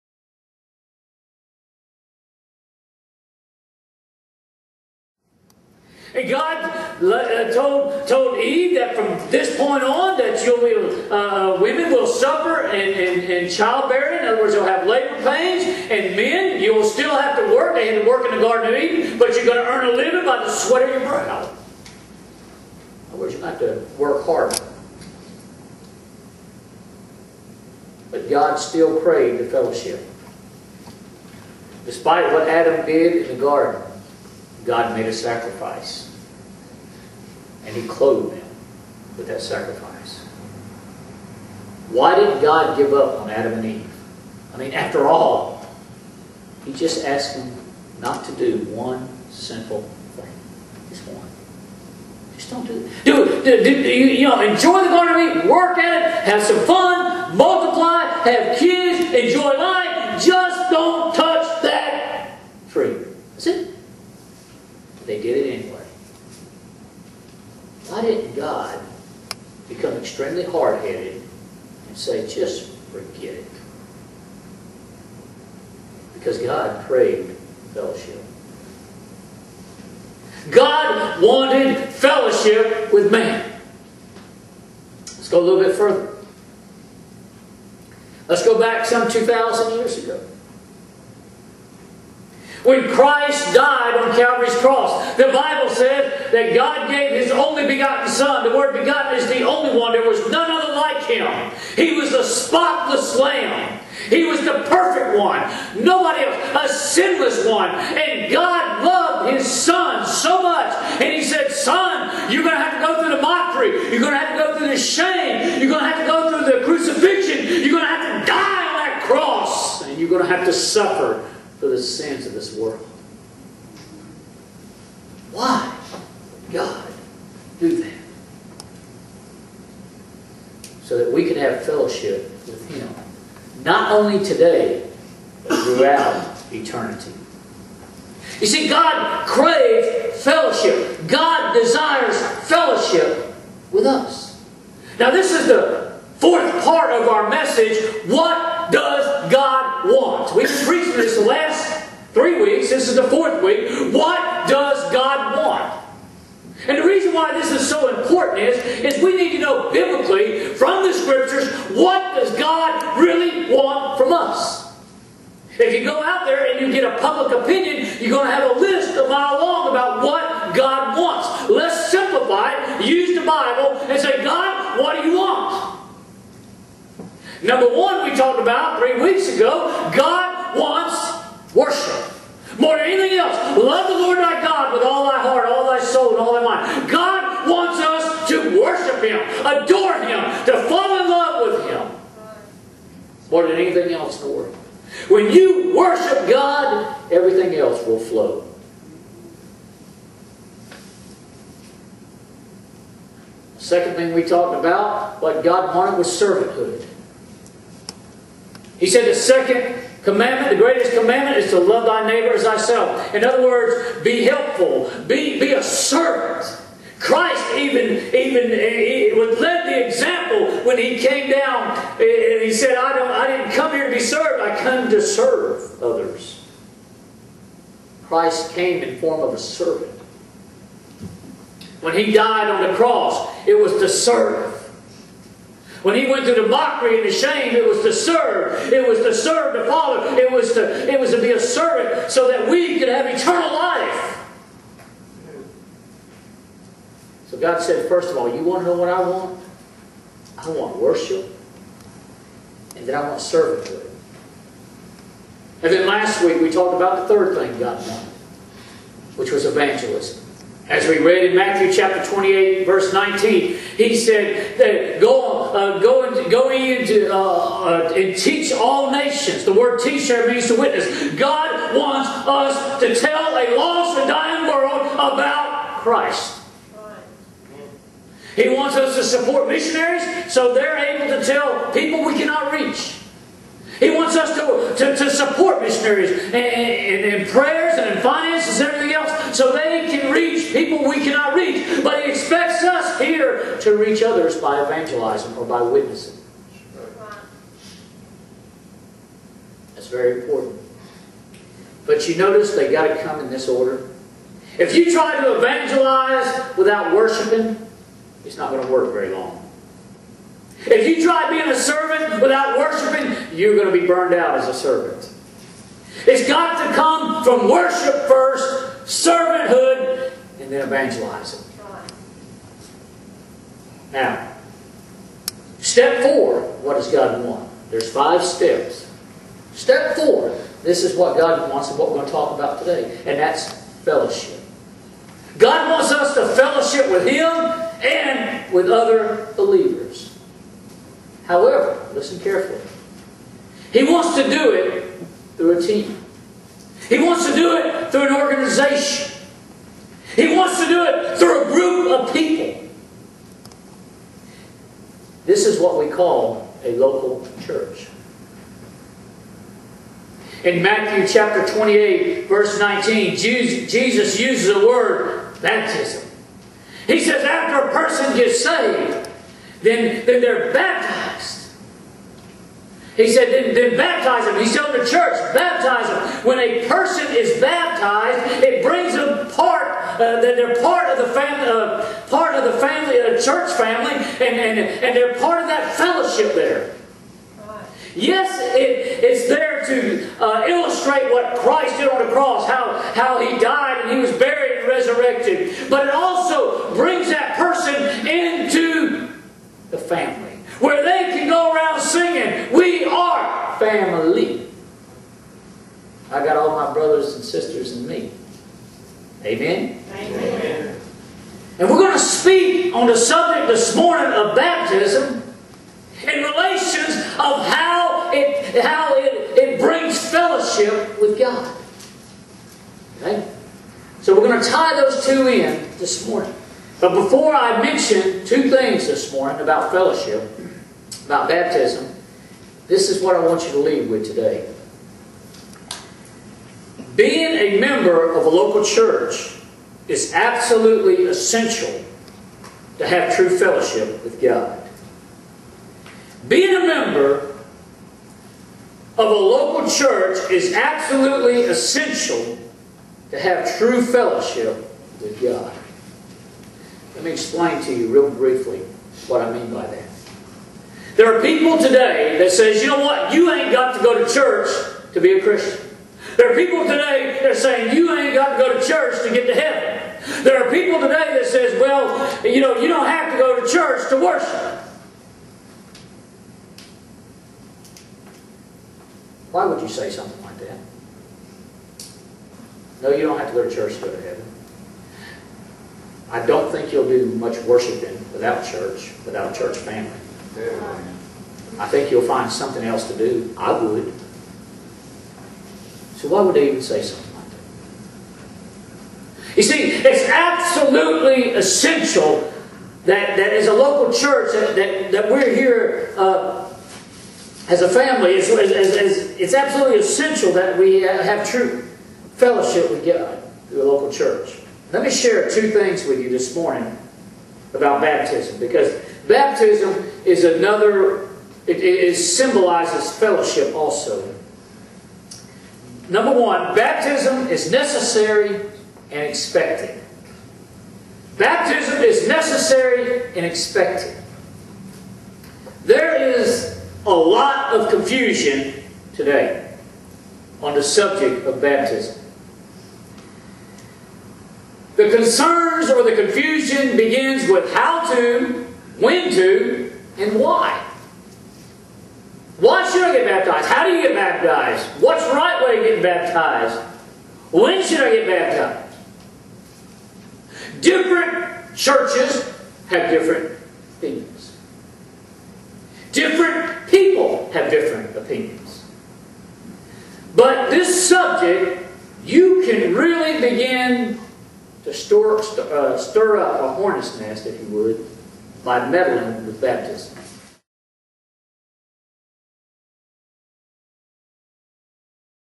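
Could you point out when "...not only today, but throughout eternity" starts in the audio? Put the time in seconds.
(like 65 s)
133 s.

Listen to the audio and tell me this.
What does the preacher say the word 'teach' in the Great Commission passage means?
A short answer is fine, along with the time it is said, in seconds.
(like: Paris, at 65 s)
To witness, at 270 s.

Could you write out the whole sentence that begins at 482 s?
No, you don't have to go to church to go to heaven.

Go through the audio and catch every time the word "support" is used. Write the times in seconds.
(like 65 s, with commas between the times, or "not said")
279 s, 285 s.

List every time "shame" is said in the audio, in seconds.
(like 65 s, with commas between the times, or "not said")
114 s, 237 s.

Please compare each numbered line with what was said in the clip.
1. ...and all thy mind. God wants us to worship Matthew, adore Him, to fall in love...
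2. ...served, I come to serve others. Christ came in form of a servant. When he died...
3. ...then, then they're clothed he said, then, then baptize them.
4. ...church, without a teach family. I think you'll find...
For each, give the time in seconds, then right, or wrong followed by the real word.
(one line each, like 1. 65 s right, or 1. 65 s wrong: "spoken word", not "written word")
1. 186 s wrong: "Him", not "Matthew"
2. 223 s right
3. 369 s wrong: "baptized", not "clothed"
4. 488 s wrong: "church", not "teach".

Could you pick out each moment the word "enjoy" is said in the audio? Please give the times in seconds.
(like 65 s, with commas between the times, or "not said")
54 s, 59 s.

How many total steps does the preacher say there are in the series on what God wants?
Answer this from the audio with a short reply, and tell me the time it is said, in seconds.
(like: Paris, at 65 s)
5, at 327 s.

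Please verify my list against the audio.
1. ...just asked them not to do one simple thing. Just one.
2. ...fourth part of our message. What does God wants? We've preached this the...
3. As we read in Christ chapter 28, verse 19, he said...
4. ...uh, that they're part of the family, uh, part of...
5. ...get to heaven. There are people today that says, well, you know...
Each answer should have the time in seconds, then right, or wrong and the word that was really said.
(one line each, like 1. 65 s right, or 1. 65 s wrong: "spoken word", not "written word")
1. 46 s right
2. 146 s right
3. 260 s wrong: "Matthew", not "Christ"
4. 379 s right
5. 469 s right.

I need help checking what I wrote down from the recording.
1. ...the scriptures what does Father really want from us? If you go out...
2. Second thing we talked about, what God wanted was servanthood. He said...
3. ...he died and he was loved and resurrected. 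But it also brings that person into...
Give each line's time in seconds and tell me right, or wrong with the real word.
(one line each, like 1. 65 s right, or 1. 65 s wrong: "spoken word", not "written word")
1. 160 s wrong: "God", not "Father"
2. 203 s right
3. 393 s wrong: "buried", not "loved".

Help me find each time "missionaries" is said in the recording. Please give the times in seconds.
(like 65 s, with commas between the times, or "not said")
279 s, 285 s.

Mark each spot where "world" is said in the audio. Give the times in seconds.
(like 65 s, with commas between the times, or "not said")
122 s, 194 s, 274 s.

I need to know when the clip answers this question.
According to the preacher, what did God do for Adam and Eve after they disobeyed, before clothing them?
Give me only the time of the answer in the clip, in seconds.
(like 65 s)
34 s.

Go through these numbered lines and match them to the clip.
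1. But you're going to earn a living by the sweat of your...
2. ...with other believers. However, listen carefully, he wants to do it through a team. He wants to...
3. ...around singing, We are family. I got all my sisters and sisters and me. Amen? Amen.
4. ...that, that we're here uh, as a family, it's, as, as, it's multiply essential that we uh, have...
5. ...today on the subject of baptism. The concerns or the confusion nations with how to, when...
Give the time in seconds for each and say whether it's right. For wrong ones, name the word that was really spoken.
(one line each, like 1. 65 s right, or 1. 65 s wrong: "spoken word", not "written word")
1. 19 s right
2. 338 s right
3. 401 s wrong: "brothers", not "sisters"
4. 504 s wrong: "absolutely", not "multiply"
5. 538 s wrong: "begins", not "nations".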